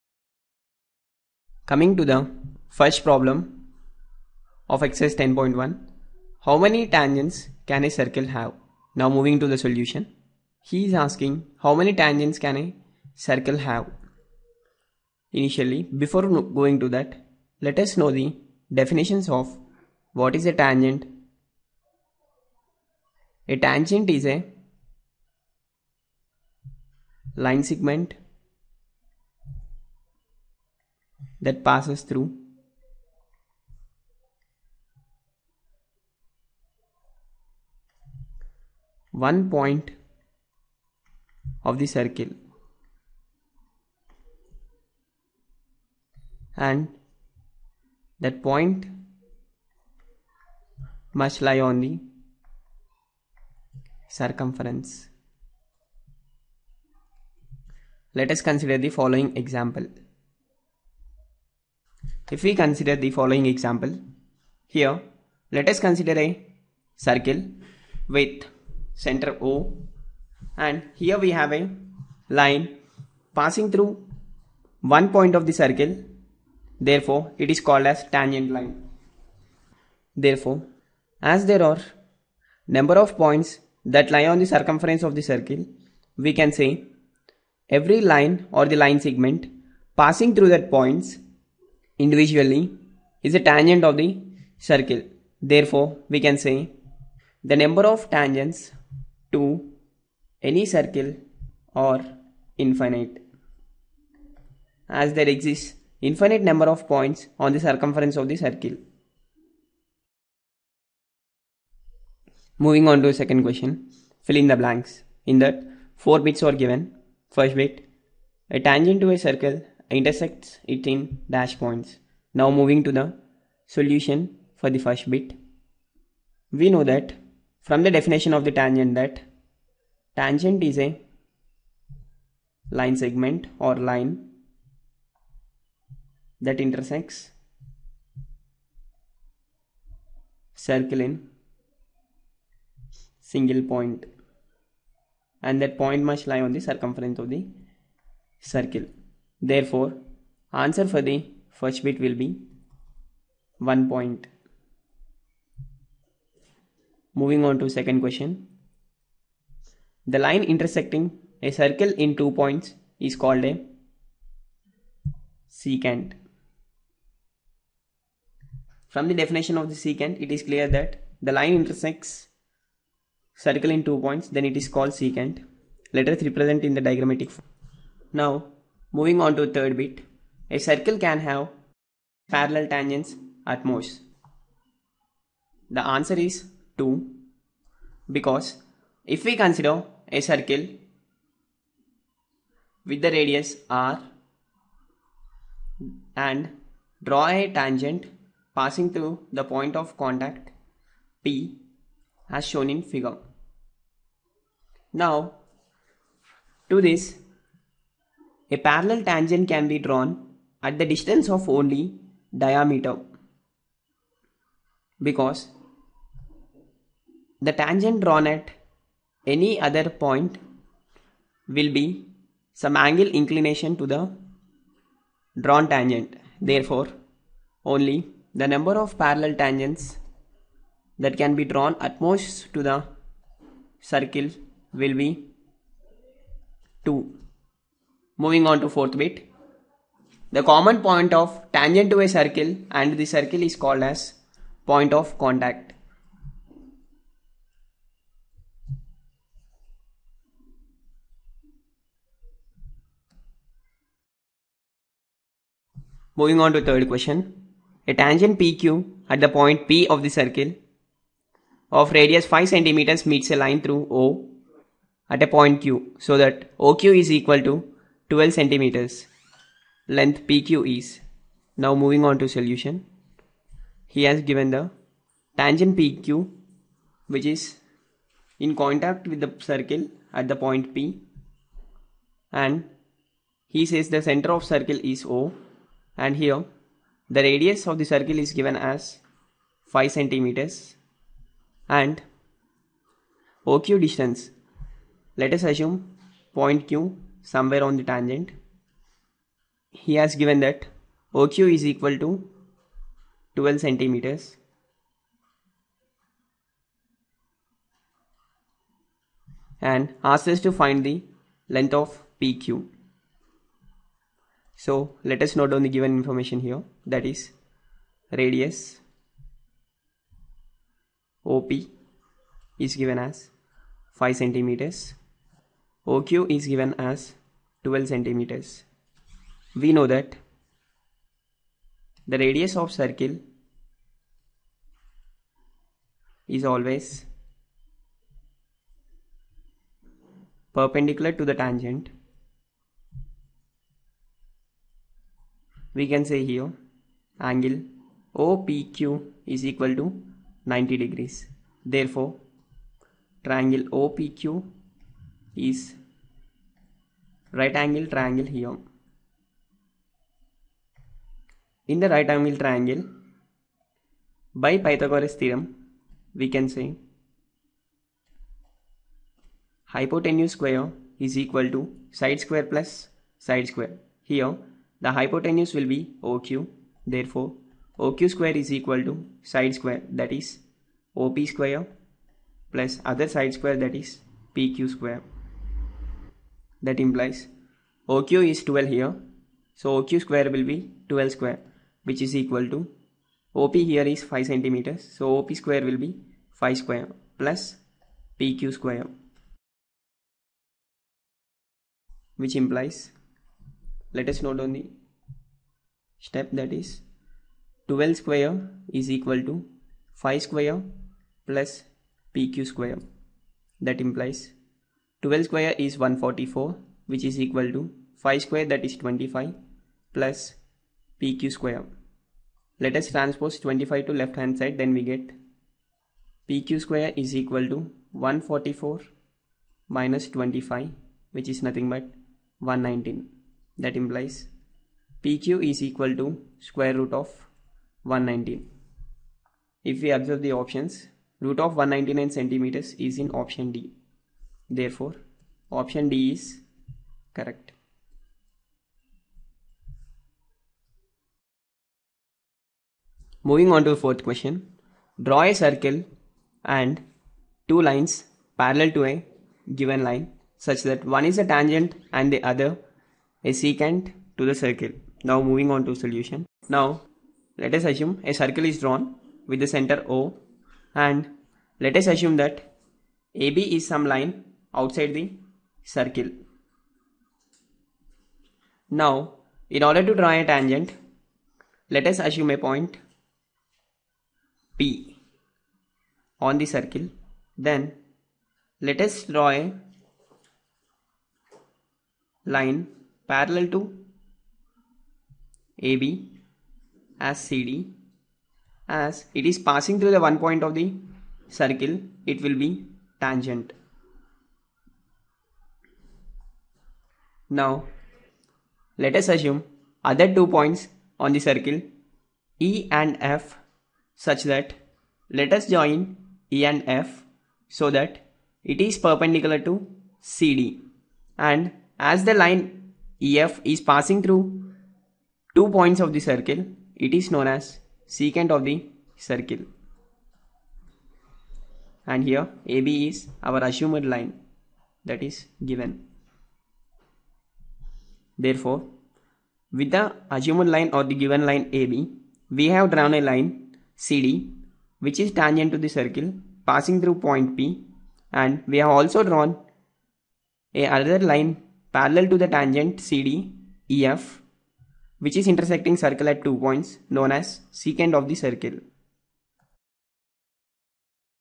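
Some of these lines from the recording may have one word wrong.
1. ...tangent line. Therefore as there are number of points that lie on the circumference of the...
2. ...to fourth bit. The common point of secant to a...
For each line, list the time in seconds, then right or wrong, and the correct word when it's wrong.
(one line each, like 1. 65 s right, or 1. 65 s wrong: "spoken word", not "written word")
1. 78 s right
2. 238 s wrong: "tangent", not "secant".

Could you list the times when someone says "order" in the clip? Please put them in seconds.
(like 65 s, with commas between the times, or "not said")
479 s.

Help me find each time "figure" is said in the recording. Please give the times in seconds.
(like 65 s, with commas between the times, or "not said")
202 s.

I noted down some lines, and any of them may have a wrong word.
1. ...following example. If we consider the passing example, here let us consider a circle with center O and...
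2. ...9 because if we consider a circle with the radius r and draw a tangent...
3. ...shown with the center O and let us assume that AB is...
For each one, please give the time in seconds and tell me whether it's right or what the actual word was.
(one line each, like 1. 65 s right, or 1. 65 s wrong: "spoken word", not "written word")
1. 58 s wrong: "following", not "passing"
2. 186 s wrong: "2", not "9"
3. 468 s wrong: "drawn", not "shown".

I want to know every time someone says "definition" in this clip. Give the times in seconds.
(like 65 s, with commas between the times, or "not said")
18 s, 127 s, 169 s.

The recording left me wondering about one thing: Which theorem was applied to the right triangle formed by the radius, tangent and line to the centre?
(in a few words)
Pythagoras theorem.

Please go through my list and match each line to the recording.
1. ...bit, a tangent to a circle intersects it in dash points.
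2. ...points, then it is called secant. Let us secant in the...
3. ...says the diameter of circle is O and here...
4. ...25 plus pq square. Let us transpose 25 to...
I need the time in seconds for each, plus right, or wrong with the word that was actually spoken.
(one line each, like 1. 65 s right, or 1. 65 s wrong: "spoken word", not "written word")
1. 117 s right
2. 173 s wrong: "represent", not "secant"
3. 283 s wrong: "center", not "diameter"
4. 418 s right.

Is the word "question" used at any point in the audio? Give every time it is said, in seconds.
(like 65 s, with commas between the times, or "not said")
113 s, 158 s, 256 s, 454 s.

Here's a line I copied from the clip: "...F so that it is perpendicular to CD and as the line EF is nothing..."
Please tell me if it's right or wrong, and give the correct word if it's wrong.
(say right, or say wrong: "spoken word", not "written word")
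wrong: "passing", not "nothing".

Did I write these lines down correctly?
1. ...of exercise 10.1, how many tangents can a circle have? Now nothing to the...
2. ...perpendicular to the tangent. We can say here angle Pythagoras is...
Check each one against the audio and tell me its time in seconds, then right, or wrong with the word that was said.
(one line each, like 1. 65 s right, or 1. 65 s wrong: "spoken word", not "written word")
1. 4 s wrong: "moving", not "nothing"
2. 340 s wrong: "OPQ", not "Pythagoras".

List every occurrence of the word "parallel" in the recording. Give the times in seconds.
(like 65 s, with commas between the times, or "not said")
182 s, 208 s, 228 s, 458 s, 493 s, 551 s.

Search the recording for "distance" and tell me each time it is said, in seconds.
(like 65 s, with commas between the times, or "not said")
210 s, 293 s.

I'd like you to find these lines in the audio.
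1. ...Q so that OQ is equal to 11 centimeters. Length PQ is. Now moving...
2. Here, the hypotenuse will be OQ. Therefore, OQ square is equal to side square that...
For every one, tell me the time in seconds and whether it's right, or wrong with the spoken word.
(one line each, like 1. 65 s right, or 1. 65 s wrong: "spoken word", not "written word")
1. 265 s wrong: "12", not "11"
2. 374 s right.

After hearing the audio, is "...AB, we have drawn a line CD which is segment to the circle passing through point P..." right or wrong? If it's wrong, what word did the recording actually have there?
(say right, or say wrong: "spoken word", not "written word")
wrong: "tangent", not "segment".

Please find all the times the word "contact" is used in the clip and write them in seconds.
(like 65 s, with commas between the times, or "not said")
199 s, 245 s, 278 s.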